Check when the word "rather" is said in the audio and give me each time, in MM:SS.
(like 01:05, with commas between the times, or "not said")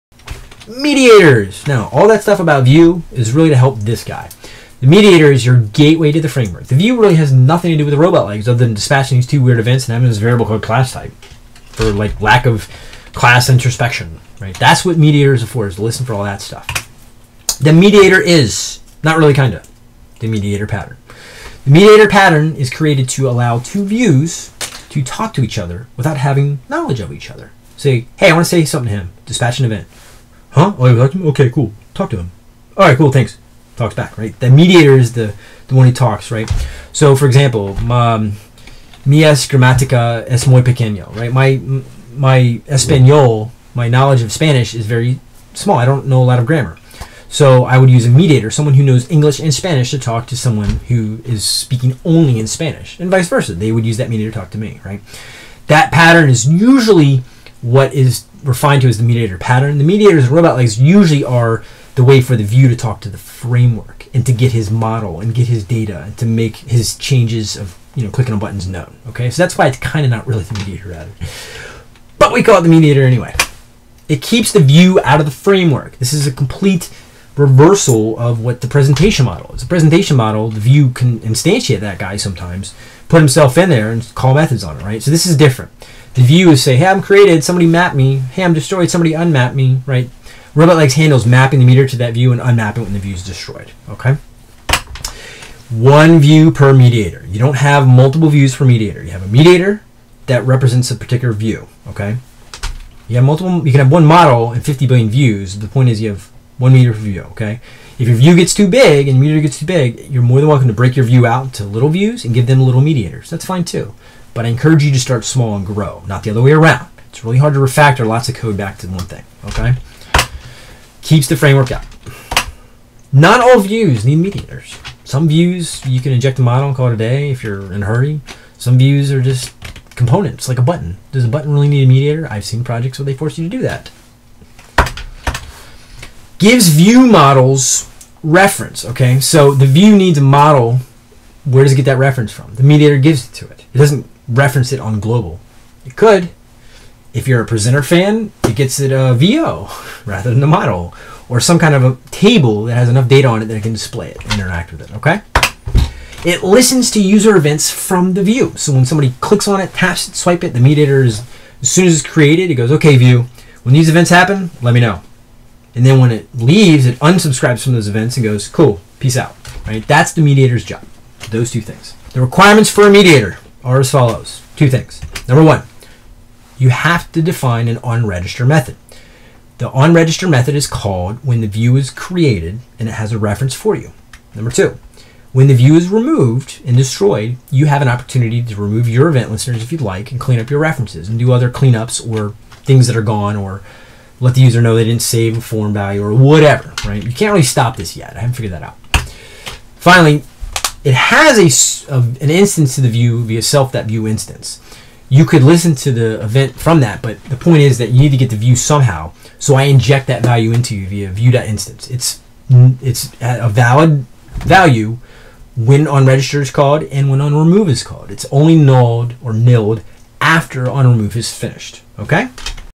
01:10, 02:30.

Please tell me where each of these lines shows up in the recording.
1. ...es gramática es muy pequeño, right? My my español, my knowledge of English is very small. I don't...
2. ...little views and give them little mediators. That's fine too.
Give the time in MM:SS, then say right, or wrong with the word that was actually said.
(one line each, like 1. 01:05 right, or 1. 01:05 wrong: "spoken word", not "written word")
1. 00:39 wrong: "Spanish", not "English"
2. 01:51 right.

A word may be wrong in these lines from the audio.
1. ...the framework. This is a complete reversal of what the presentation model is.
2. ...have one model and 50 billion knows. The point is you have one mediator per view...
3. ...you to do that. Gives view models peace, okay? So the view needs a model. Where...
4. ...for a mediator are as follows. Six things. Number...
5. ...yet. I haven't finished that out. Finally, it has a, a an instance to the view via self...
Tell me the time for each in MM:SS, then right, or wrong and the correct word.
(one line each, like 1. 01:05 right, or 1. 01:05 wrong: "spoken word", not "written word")
1. 01:15 right
2. 01:43 wrong: "views", not "knows"
3. 02:13 wrong: "reference", not "peace"
4. 02:52 wrong: "Two", not "Six"
5. 03:17 wrong: "figured", not "finished".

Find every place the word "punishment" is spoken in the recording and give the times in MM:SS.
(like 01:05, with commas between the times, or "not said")
not said.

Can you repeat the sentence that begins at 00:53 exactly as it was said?
They would use that mediator to talk to me, right?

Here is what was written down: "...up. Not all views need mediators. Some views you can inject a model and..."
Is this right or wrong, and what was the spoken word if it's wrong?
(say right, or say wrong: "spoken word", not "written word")
right.